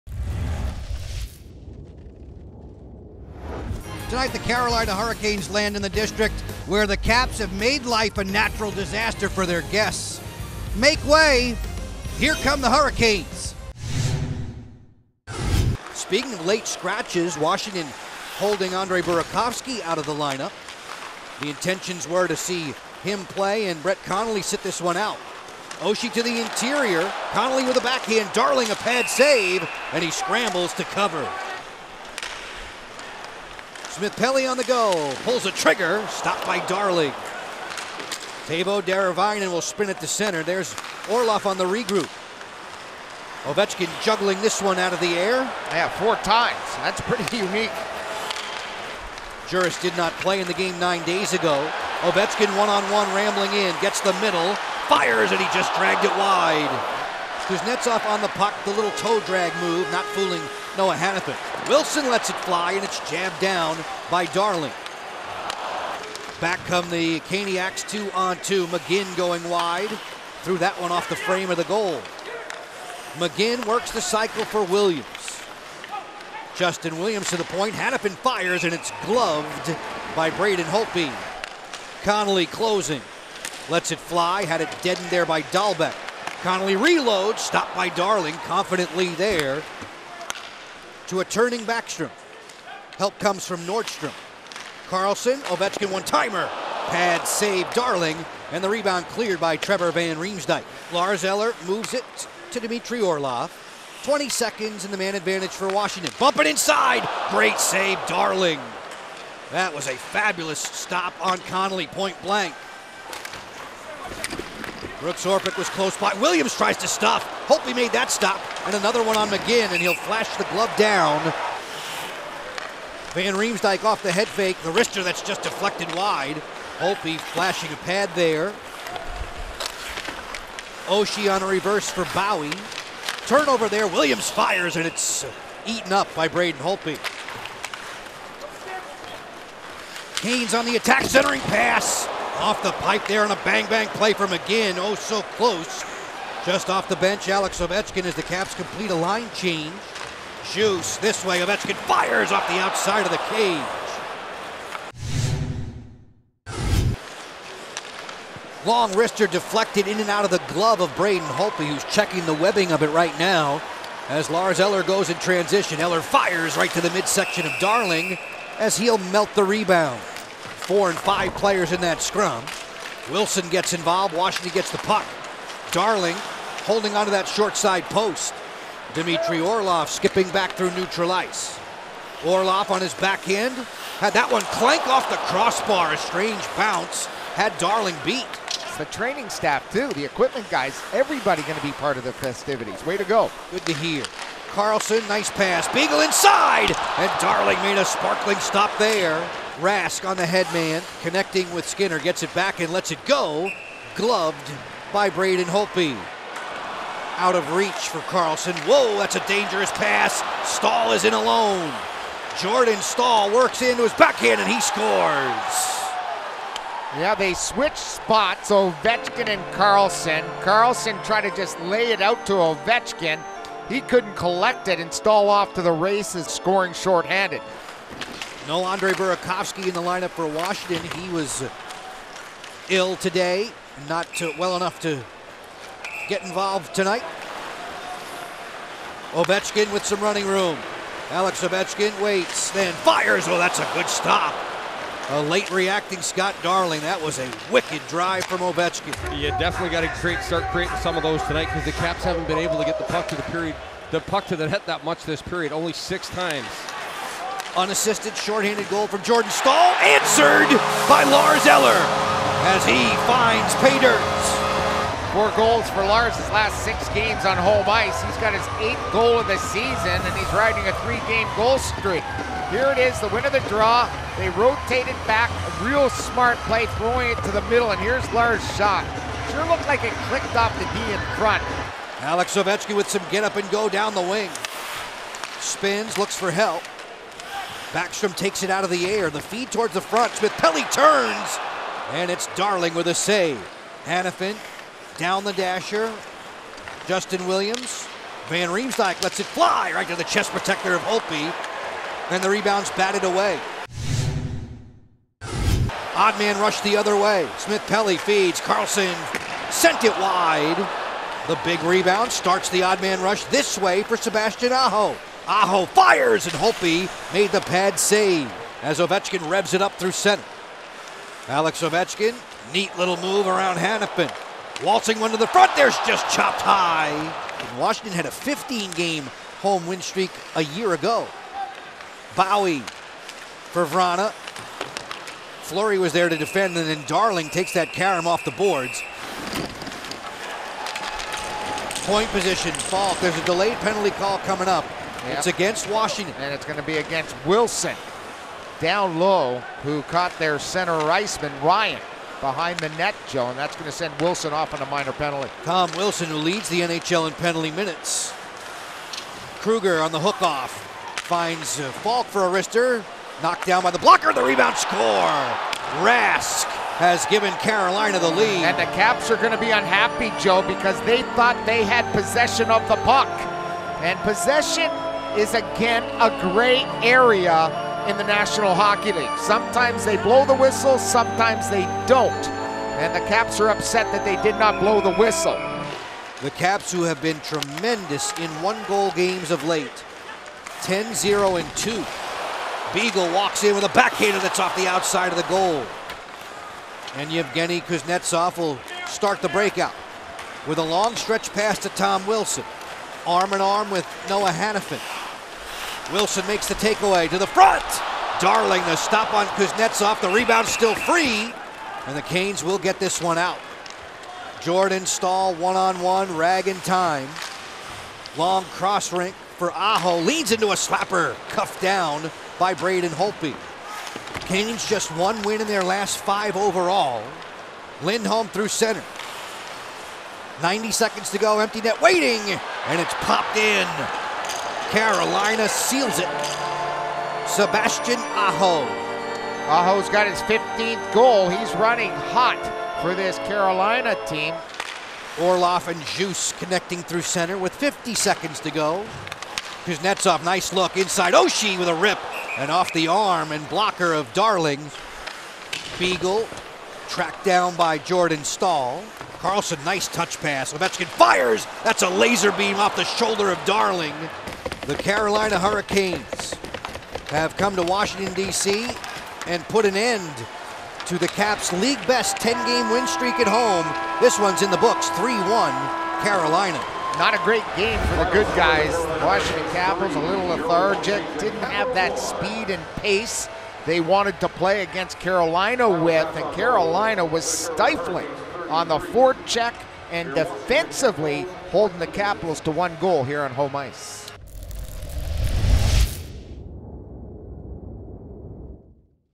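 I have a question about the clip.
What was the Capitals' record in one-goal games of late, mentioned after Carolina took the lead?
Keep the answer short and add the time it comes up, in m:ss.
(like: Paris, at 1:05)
10-0-2, at 6:30.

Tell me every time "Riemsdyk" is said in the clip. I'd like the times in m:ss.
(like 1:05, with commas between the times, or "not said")
1:40, 2:03, 4:58.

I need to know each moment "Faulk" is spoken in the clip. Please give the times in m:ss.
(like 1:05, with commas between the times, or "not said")
5:42, 6:01.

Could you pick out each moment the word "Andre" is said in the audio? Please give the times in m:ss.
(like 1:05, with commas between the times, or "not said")
0:18, 3:48.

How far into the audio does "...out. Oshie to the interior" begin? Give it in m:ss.
0:24.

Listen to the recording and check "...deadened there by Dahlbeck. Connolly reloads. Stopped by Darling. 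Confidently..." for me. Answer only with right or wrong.
right.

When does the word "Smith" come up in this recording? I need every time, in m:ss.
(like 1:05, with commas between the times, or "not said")
0:33, 4:50, 5:07.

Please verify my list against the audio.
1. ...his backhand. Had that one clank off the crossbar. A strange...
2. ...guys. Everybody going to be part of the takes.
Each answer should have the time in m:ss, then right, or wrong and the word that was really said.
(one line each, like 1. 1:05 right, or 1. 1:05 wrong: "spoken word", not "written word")
1. 3:02 right
2. 3:10 wrong: "festivities", not "takes".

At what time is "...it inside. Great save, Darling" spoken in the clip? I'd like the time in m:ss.
1:46.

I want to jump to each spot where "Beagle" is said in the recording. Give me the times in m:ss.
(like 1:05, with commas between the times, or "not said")
3:15, 6:32, 7:35.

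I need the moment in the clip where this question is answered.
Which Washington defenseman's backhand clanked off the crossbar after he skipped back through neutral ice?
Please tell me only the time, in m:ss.
2:58.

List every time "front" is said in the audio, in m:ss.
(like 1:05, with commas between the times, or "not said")
4:41, 4:49, 5:25, 6:47.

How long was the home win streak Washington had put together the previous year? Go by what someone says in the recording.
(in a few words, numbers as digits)
15 games.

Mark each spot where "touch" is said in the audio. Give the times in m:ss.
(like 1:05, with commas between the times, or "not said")
7:39.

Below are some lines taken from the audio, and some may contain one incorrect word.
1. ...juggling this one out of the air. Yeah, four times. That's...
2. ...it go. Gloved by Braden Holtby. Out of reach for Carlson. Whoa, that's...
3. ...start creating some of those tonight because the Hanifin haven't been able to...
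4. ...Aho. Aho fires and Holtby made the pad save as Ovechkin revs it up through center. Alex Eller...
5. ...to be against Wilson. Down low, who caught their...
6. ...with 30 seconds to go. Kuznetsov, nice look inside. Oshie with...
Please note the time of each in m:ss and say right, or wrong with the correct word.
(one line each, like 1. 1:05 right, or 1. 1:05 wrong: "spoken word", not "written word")
1. 0:44 right
2. 3:22 right
3. 4:10 wrong: "Caps", not "Hanifin"
4. 5:14 wrong: "Ovechkin", not "Eller"
5. 5:46 right
6. 7:27 wrong: "50", not "30".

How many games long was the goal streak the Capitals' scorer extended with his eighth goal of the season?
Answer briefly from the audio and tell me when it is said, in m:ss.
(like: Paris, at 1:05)
3, at 4:30.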